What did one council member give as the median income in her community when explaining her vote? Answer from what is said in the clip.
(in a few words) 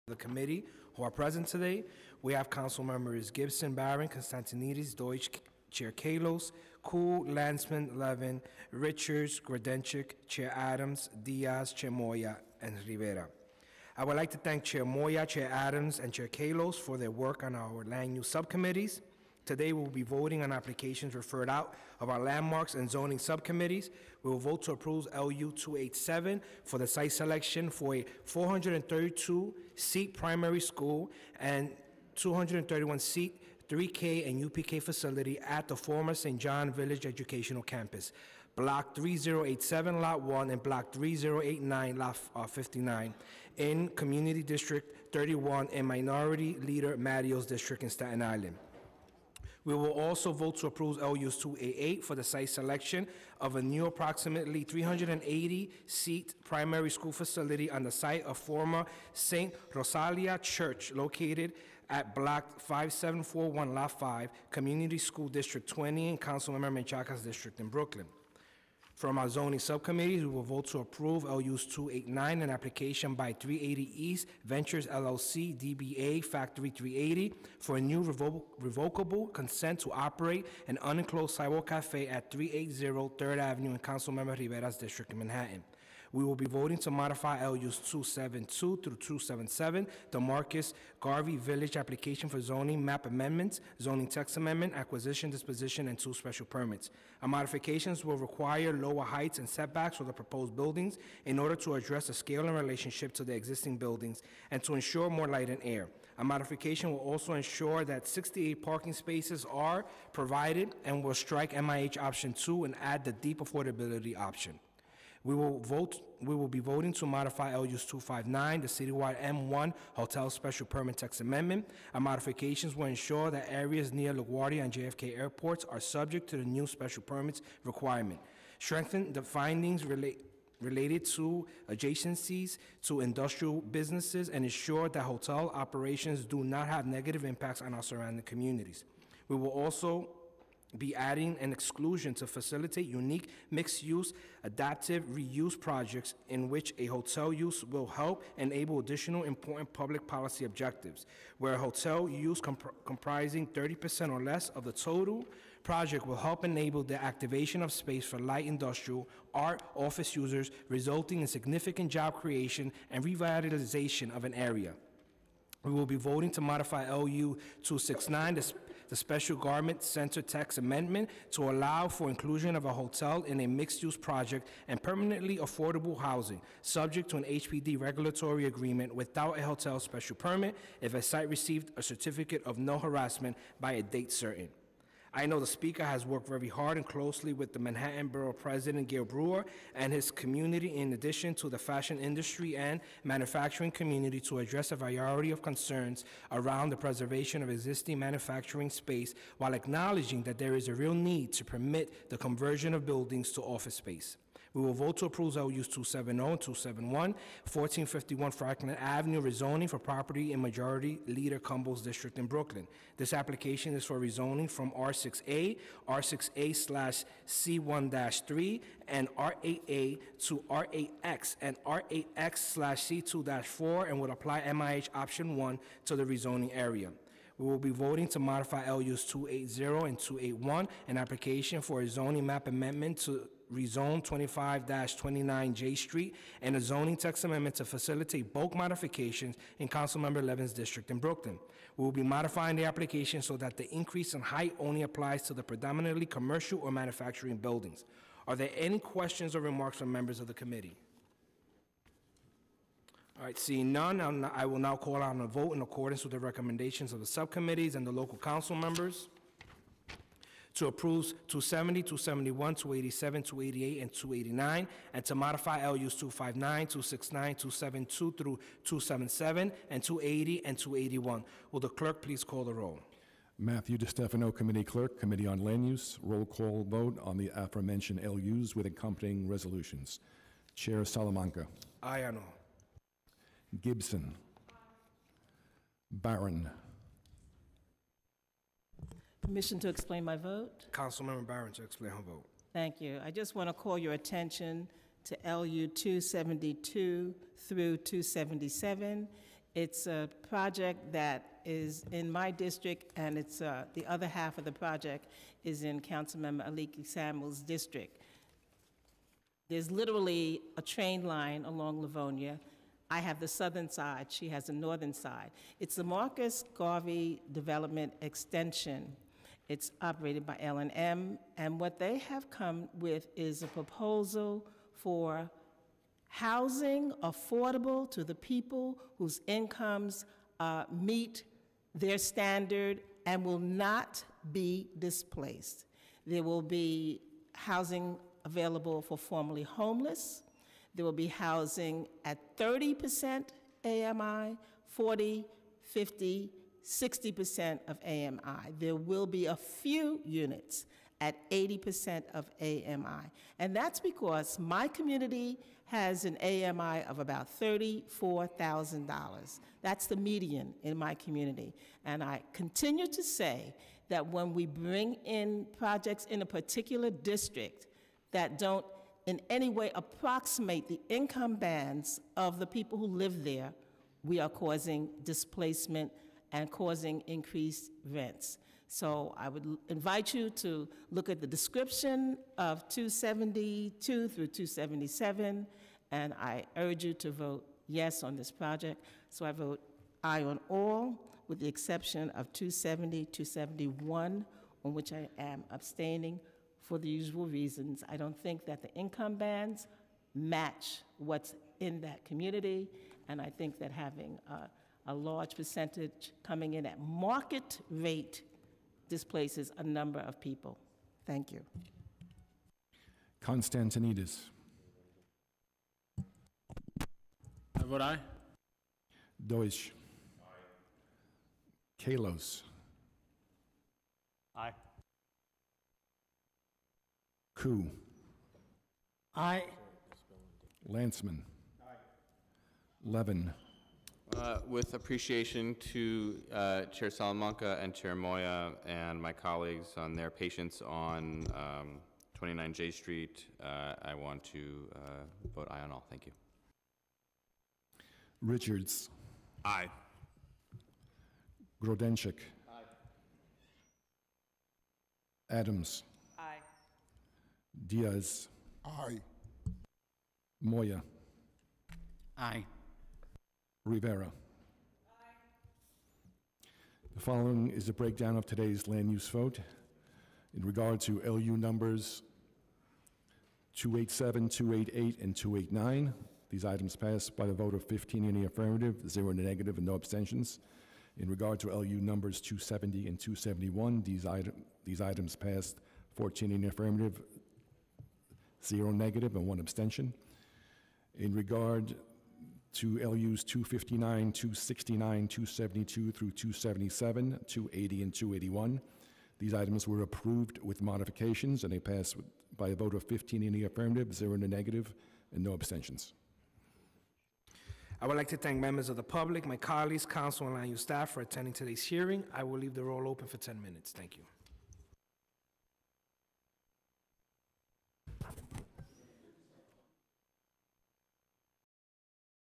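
$34,000.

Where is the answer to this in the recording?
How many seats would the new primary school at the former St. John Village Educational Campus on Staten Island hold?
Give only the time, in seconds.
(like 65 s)
28 s.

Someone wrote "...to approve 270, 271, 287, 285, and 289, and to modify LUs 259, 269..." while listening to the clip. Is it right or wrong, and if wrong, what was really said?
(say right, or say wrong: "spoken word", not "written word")
wrong: "288", not "285".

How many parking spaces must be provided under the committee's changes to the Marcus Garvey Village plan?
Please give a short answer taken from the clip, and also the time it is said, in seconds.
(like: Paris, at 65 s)
68, at 108 s.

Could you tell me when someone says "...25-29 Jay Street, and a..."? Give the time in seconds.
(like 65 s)
234 s.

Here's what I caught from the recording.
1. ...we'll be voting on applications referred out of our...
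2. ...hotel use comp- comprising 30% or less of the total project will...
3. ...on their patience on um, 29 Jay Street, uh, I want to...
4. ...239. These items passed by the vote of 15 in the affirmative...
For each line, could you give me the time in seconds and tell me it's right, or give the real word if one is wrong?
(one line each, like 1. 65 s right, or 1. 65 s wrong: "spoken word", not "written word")
1. 19 s right
2. 151 s right
3. 439 s right
4. 475 s wrong: "289", not "239".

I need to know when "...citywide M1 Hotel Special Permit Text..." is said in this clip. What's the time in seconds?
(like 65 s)
118 s.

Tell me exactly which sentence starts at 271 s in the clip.
Will the clerk please call the roll?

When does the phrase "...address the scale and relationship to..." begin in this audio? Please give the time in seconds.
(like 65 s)
101 s.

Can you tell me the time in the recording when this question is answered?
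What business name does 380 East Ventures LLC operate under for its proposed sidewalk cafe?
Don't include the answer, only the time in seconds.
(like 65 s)
76 s.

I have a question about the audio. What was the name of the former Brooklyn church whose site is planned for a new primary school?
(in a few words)
St. Rosalia Church.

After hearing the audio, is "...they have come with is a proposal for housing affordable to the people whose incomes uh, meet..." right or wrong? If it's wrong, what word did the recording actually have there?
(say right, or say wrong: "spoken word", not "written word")
right.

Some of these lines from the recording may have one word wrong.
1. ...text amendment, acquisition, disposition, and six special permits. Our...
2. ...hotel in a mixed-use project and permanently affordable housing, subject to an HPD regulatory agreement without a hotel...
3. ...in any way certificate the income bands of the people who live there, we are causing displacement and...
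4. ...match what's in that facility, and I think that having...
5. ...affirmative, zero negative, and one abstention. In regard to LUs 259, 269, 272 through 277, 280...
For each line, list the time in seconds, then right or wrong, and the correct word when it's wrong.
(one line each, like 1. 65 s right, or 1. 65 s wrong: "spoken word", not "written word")
1. 94 s wrong: "two", not "six"
2. 172 s right
3. 369 s wrong: "approximate", not "certificate"
4. 400 s wrong: "community", not "facility"
5. 486 s right.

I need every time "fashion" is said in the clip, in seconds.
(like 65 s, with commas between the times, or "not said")
191 s.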